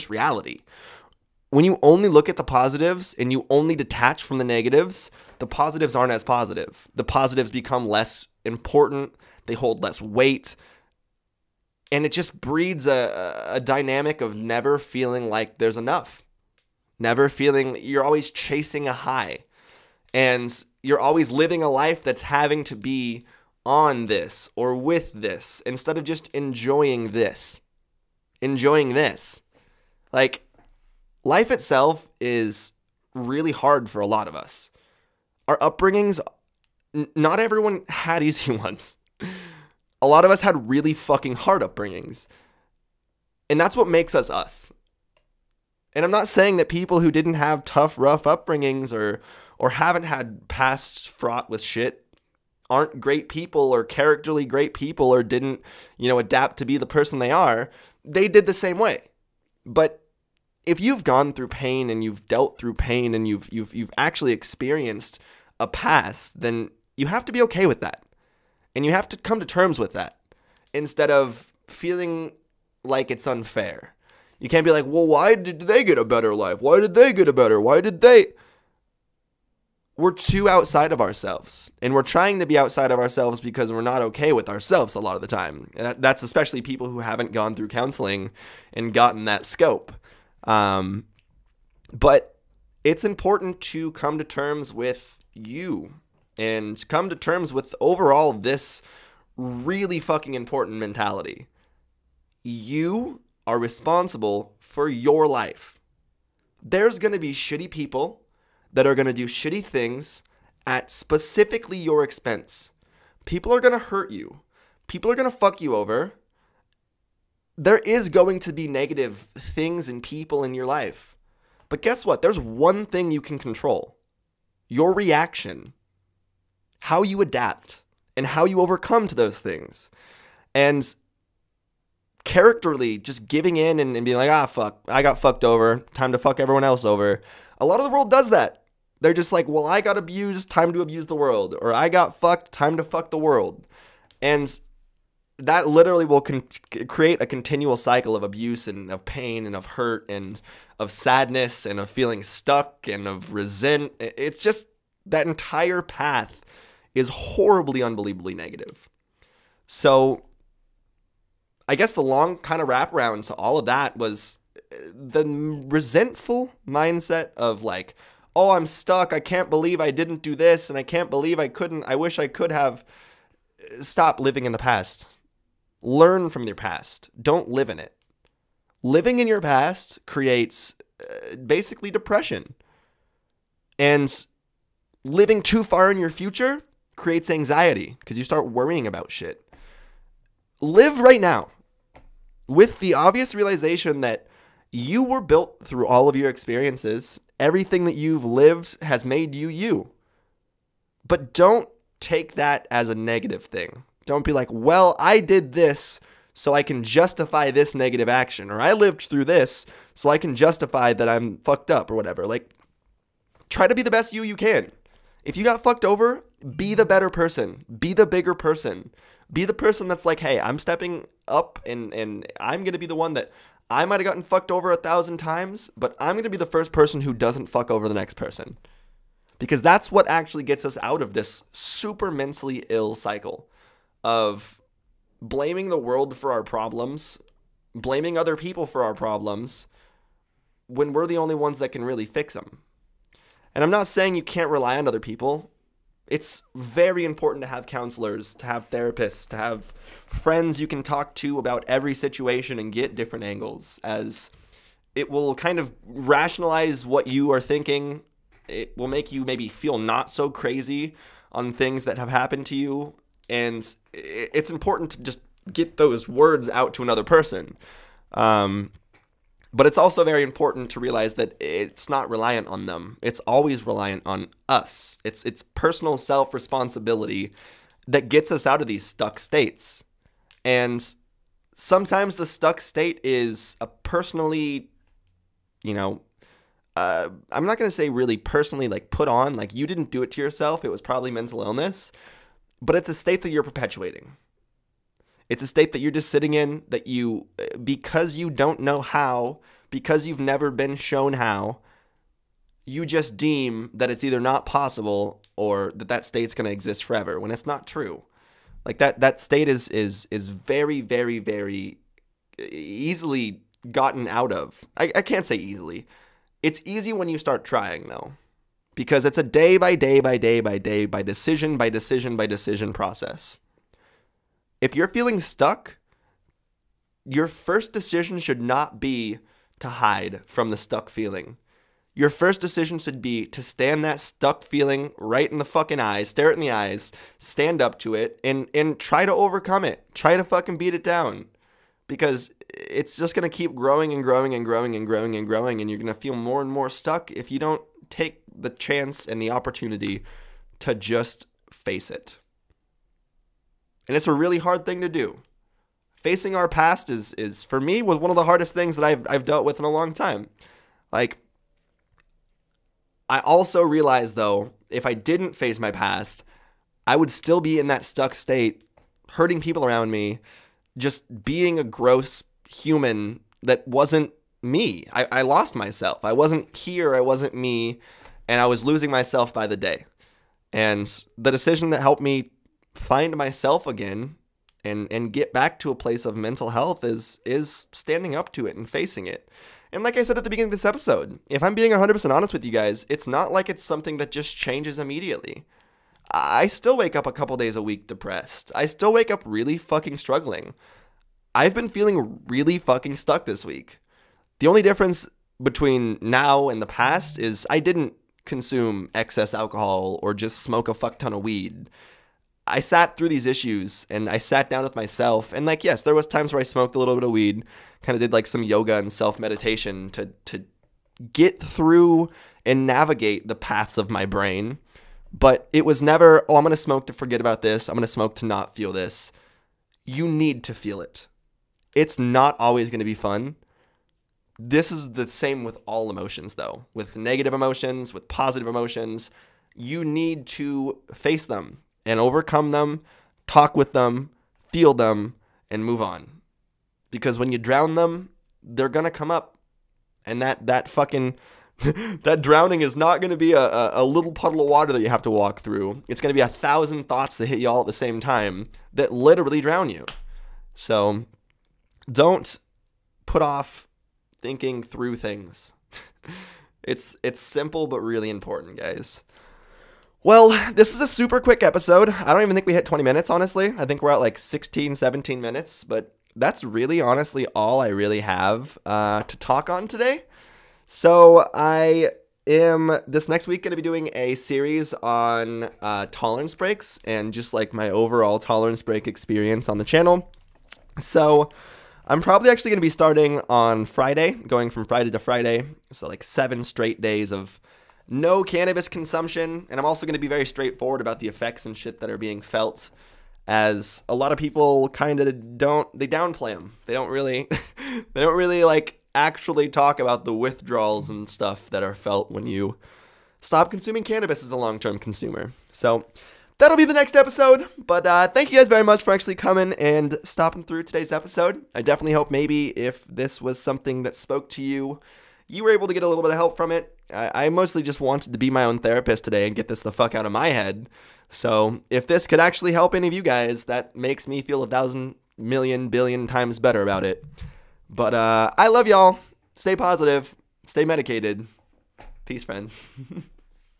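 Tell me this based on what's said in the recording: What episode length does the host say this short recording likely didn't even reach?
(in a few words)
20 minutes.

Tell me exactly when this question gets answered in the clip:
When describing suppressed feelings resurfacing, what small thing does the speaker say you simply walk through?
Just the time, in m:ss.
7:33.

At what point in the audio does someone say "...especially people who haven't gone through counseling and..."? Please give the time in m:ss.
1:26.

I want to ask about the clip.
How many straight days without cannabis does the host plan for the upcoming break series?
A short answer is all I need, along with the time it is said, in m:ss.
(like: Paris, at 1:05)
7, at 8:16.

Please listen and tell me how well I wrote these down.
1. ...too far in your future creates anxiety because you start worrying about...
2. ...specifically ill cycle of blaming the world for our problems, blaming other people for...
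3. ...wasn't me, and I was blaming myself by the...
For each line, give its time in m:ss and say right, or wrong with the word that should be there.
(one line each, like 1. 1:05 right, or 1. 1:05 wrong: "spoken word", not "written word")
1. 3:05 right
2. 3:52 wrong: "mentally", not "specifically"
3. 6:17 wrong: "losing", not "blaming".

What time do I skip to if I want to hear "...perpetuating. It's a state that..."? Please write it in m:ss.
4:53.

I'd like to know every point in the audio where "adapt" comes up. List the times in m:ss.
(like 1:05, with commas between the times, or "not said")
0:56, 2:07.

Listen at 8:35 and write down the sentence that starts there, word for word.
So, that'll be the next episode.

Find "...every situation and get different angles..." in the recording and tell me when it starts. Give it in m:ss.
4:11.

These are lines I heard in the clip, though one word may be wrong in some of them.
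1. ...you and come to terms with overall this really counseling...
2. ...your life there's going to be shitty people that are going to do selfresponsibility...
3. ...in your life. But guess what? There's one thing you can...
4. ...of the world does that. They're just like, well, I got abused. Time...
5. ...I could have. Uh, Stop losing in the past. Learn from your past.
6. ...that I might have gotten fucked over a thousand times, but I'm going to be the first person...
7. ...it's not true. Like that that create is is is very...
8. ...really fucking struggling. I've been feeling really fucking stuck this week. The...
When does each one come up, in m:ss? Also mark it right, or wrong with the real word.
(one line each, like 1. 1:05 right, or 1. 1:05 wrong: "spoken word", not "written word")
1. 1:35 wrong: "fucking", not "counseling"
2. 1:44 wrong: "shitty", not "selfresponsibility"
3. 2:00 right
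4. 2:17 right
5. 2:52 wrong: "living", not "losing"
6. 3:43 right
7. 5:07 wrong: "state", not "create"
8. 6:39 right.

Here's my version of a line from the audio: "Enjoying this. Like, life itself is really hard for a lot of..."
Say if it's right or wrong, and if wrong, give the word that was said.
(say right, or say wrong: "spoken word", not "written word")
right.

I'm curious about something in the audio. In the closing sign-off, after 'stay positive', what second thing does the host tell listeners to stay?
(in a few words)
medicated.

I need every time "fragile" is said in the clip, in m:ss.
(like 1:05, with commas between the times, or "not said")
not said.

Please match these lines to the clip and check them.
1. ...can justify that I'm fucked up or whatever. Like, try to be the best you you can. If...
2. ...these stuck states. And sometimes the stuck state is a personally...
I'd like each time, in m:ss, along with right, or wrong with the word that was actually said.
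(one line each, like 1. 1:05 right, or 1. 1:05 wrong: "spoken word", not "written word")
1. 3:30 right
2. 4:38 right.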